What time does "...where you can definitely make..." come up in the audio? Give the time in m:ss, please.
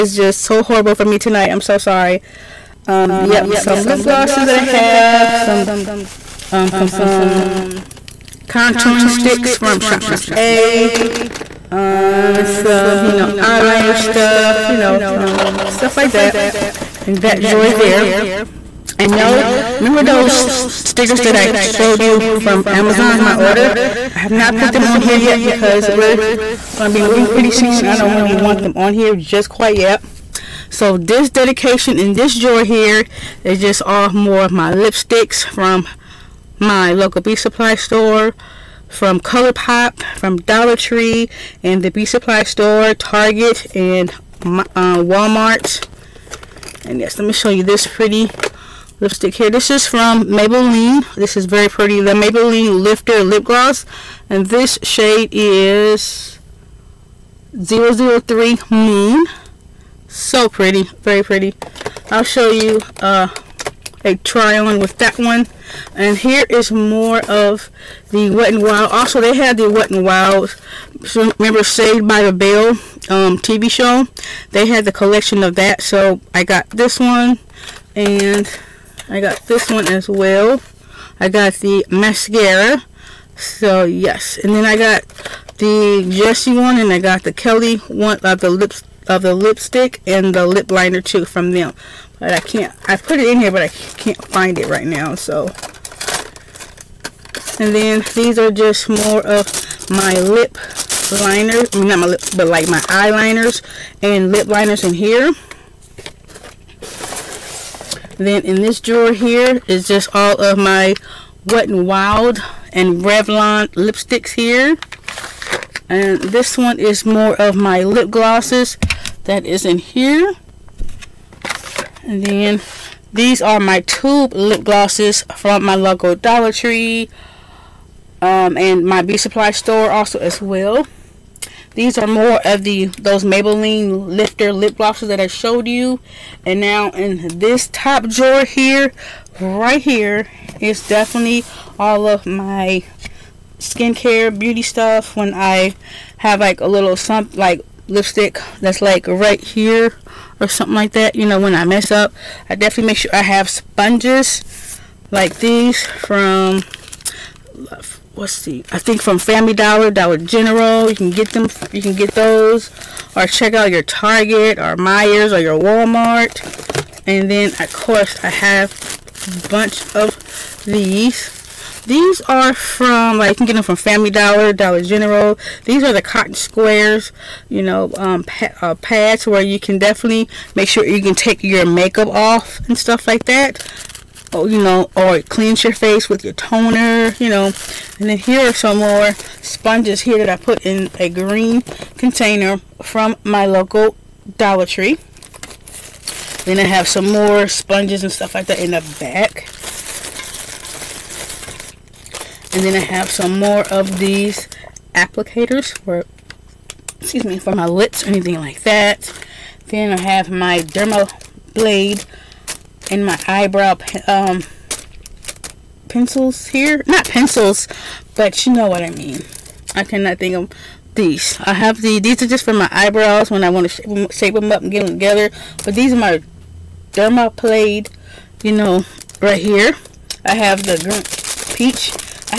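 2:59.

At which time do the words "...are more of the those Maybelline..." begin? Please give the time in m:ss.
2:11.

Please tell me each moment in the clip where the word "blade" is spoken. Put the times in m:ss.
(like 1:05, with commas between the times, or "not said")
3:31, 3:47.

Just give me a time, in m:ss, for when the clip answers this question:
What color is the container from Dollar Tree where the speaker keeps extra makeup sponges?
3:11.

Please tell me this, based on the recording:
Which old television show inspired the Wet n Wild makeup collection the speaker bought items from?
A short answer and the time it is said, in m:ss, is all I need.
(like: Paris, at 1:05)
Saved by the Bell, at 1:11.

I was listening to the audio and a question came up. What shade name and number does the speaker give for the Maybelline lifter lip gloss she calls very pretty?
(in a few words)
003 Moon.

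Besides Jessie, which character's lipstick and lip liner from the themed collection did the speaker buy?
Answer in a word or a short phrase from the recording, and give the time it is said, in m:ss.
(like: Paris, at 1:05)
Kelly, at 1:27.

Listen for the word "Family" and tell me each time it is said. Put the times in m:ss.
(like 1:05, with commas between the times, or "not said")
2:39, 2:53.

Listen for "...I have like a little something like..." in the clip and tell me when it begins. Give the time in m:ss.
2:25.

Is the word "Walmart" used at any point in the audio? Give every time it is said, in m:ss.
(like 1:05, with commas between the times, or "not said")
0:45, 2:45.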